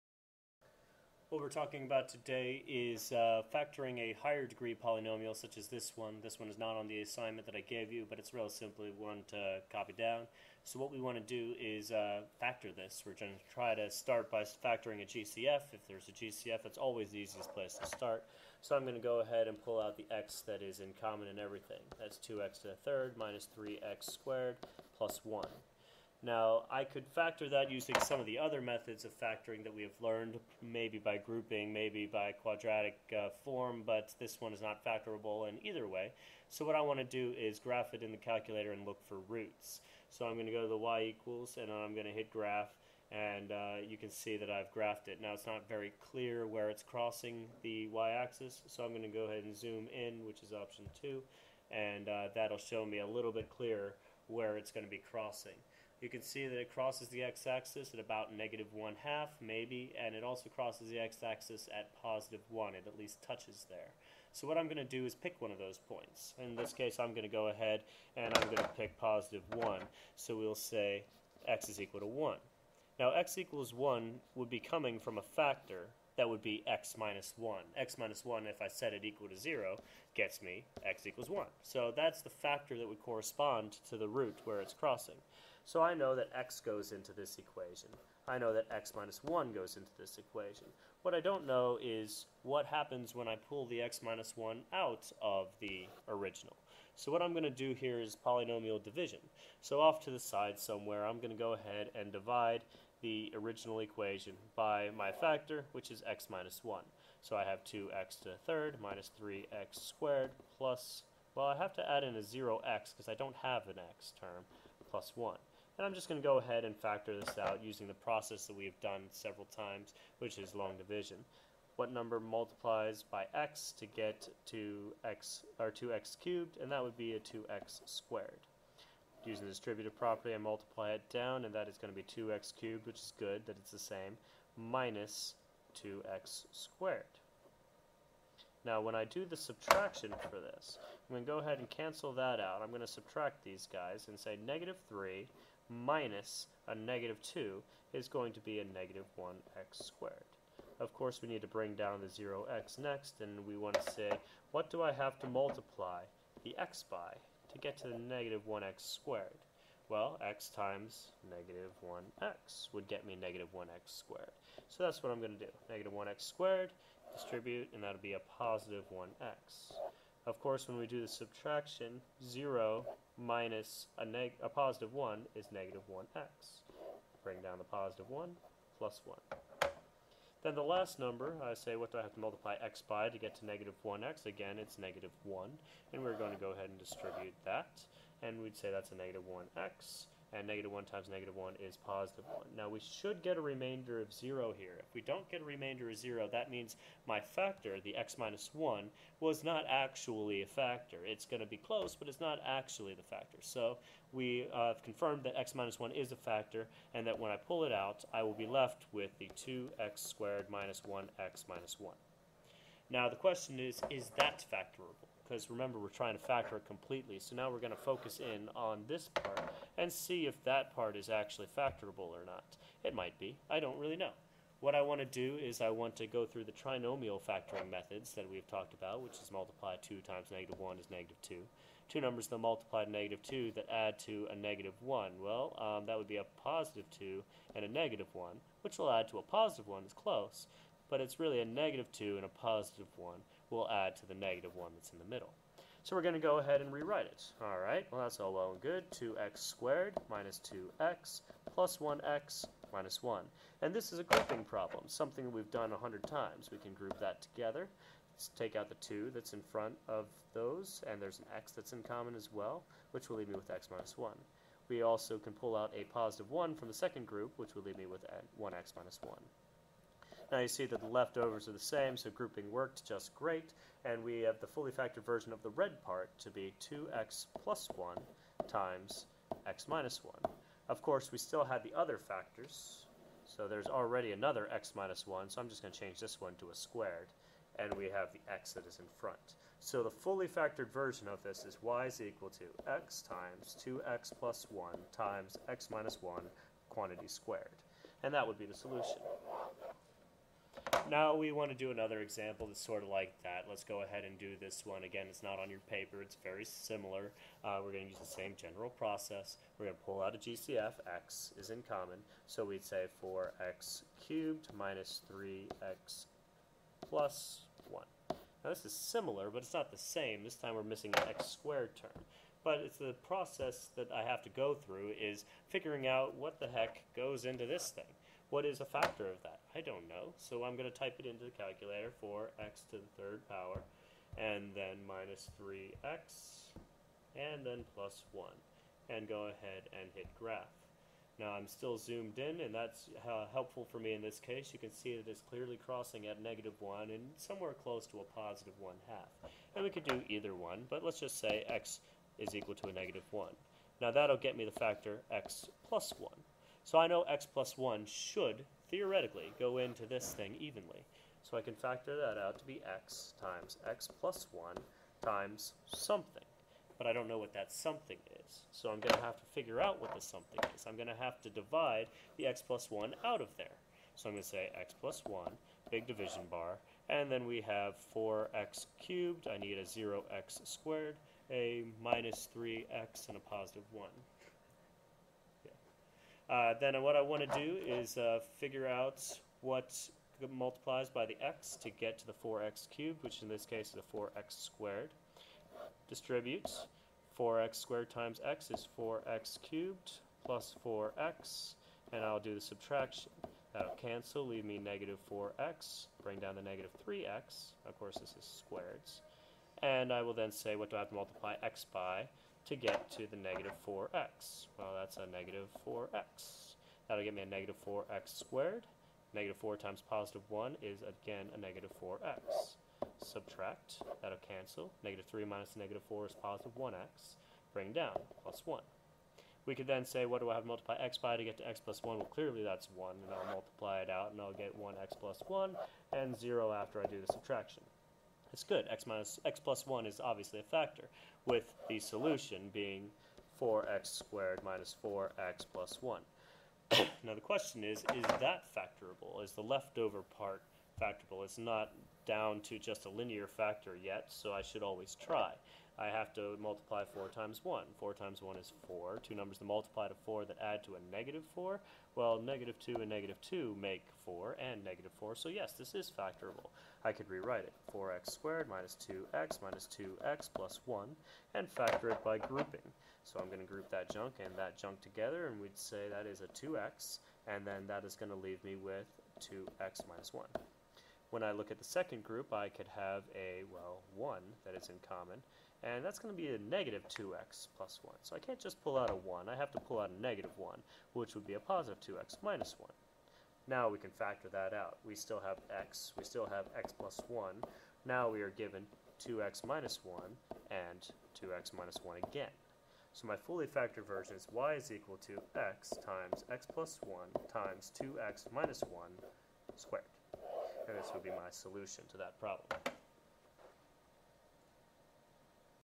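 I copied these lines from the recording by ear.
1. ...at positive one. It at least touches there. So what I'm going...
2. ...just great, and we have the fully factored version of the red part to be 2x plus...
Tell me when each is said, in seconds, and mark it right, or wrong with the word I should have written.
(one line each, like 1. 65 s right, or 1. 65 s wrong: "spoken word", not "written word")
1. 61 s right
2. 272 s right.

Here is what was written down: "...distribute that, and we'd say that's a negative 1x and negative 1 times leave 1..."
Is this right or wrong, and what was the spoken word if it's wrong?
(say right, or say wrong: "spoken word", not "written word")
wrong: "negative", not "leave".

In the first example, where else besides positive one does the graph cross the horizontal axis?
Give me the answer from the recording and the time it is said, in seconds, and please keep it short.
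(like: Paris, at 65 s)
-1/2, at 58 s.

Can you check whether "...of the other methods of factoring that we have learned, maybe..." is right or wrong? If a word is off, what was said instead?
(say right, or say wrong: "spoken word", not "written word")
right.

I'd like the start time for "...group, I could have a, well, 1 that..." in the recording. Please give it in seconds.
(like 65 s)
482 s.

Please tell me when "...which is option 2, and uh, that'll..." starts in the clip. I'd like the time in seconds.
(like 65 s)
50 s.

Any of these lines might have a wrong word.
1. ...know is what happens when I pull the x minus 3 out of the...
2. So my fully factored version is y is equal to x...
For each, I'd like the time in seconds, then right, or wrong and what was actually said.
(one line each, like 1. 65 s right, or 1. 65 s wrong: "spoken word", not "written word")
1. 91 s wrong: "1", not "3"
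2. 502 s right.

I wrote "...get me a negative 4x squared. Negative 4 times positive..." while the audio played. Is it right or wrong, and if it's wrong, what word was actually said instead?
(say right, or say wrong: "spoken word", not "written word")
right.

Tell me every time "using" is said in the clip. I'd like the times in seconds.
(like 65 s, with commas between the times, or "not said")
27 s, 117 s.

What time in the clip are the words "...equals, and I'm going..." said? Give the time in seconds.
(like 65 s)
41 s.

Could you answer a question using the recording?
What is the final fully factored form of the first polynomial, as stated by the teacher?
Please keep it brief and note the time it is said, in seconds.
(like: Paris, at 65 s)
x(2x+1)(x-1)^2, at 292 s.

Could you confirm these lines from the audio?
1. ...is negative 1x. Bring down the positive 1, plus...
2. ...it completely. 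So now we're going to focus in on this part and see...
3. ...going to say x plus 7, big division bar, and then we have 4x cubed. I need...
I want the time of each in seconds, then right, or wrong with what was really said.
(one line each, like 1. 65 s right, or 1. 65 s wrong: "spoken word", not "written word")
1. 175 s right
2. 216 s right
3. 374 s wrong: "1", not "7".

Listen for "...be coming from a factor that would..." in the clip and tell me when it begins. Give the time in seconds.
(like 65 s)
74 s.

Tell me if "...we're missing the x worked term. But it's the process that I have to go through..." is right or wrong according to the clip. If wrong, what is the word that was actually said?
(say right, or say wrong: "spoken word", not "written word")
wrong: "squared", not "worked".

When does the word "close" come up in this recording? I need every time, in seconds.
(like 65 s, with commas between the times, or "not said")
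201 s, 239 s, 347 s.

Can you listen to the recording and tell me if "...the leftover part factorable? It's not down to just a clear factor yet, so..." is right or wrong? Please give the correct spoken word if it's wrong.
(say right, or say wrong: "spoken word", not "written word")
wrong: "linear", not "clear".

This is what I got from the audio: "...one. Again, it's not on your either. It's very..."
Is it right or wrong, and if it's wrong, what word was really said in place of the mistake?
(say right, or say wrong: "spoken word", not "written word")
wrong: "paper", not "either".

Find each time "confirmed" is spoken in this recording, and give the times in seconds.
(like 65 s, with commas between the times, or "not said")
204 s.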